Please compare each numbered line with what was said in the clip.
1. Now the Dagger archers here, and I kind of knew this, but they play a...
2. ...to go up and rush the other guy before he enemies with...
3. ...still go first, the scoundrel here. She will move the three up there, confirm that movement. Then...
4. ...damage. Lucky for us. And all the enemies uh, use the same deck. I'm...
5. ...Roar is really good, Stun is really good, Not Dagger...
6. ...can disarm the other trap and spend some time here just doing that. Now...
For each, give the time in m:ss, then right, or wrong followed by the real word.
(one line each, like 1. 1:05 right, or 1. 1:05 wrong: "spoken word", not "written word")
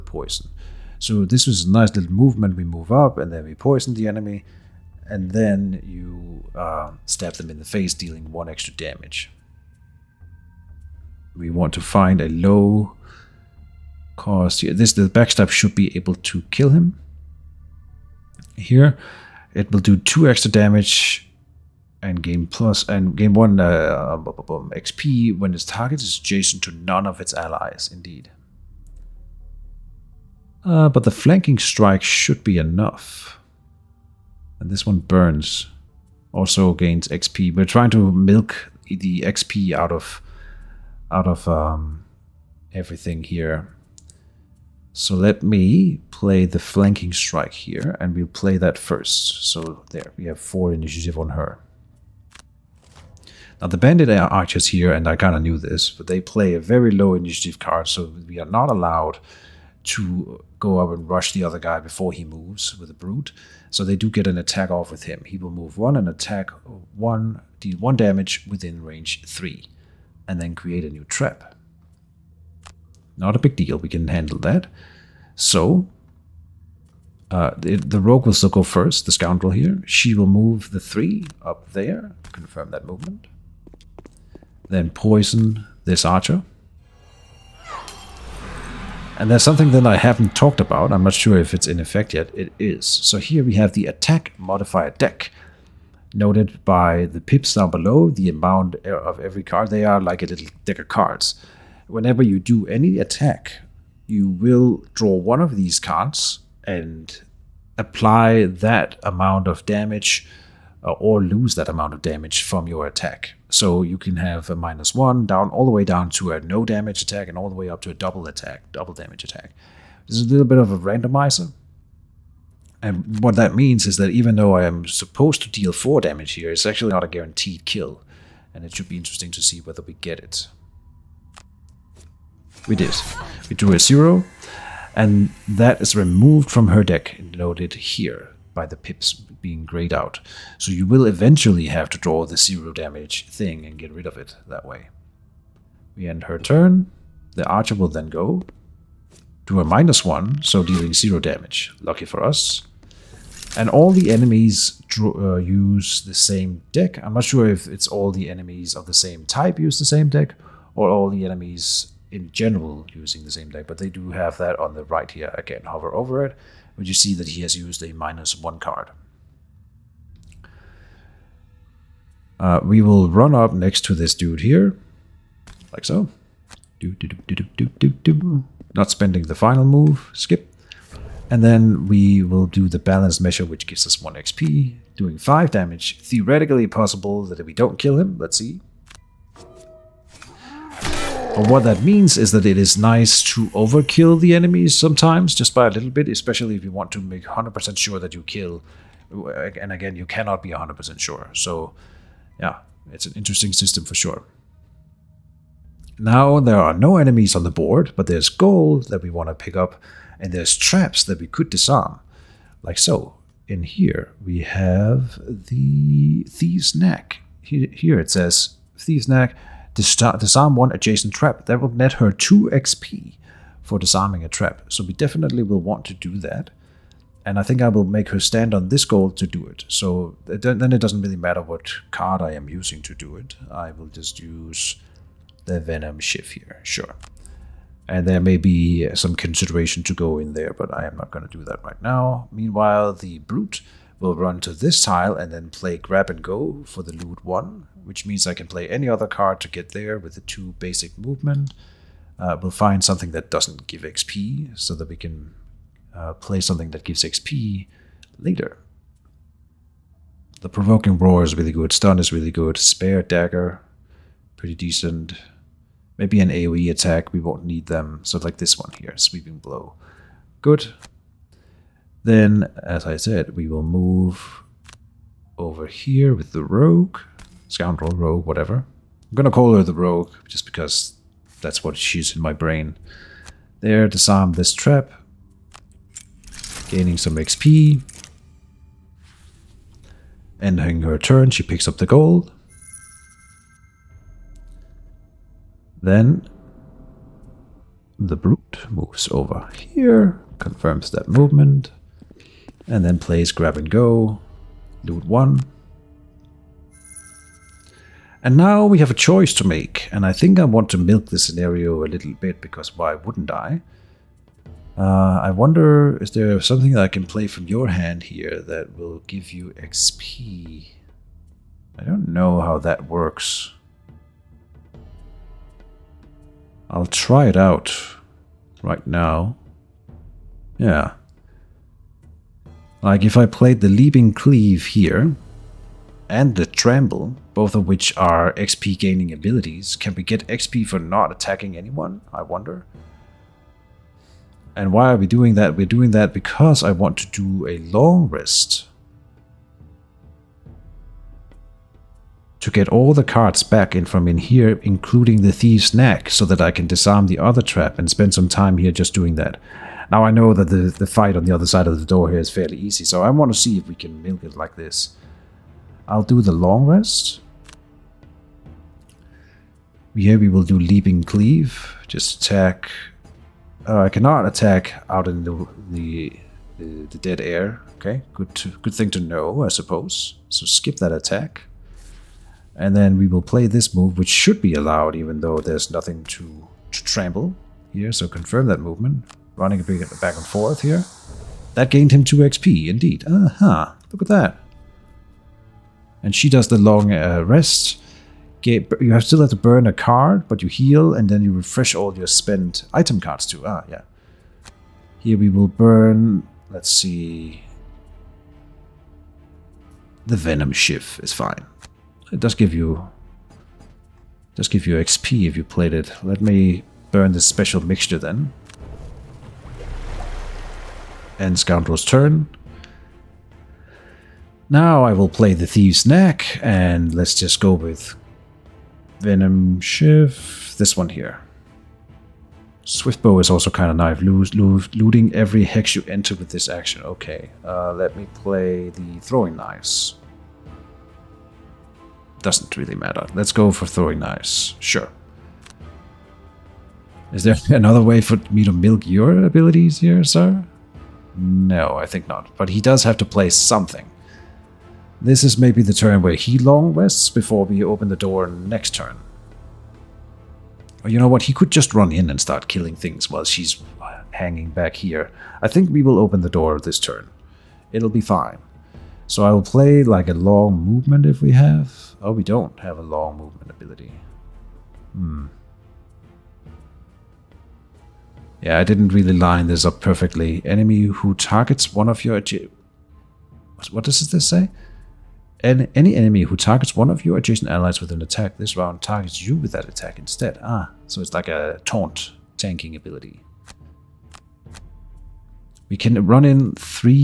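1. 0:53 wrong: "Bandit", not "Dagger"
2. 0:59 wrong: "moves", not "enemies"
3. 1:18 right
4. 2:31 right
5. 4:20 wrong: "Spare", not "Not"
6. 5:56 right.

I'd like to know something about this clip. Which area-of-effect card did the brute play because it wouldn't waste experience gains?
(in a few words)
Sweeping Blow.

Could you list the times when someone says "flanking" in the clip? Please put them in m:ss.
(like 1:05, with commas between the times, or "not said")
0:31, 0:46.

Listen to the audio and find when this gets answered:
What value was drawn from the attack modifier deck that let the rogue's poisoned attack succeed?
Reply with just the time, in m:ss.
2:13.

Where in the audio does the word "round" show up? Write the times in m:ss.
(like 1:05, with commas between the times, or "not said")
8:08.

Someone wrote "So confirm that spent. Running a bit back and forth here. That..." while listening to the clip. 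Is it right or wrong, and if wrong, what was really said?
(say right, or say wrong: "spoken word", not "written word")
wrong: "movement", not "spent".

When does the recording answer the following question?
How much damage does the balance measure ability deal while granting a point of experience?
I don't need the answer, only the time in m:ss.
3:04.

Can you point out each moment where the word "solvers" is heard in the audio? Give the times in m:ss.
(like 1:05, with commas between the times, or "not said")
not said.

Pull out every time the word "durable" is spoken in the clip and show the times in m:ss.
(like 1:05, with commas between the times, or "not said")
not said.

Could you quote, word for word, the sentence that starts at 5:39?
Can we get XP for not attacking anyone, I wonder?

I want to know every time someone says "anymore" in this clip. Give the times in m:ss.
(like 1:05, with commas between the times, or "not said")
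not said.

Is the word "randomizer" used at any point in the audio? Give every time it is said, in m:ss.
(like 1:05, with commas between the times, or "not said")
2:00.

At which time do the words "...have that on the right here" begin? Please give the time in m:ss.
2:44.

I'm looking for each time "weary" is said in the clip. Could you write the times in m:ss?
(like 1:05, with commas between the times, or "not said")
not said.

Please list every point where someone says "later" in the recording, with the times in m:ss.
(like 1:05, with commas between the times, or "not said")
4:18.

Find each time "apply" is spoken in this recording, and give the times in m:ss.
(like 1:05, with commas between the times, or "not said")
1:47.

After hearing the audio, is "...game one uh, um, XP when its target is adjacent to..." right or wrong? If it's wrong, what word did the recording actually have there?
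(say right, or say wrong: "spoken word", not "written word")
right.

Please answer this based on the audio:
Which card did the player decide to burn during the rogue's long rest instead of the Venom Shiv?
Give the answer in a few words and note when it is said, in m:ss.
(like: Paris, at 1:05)
special mixture, at 6:57.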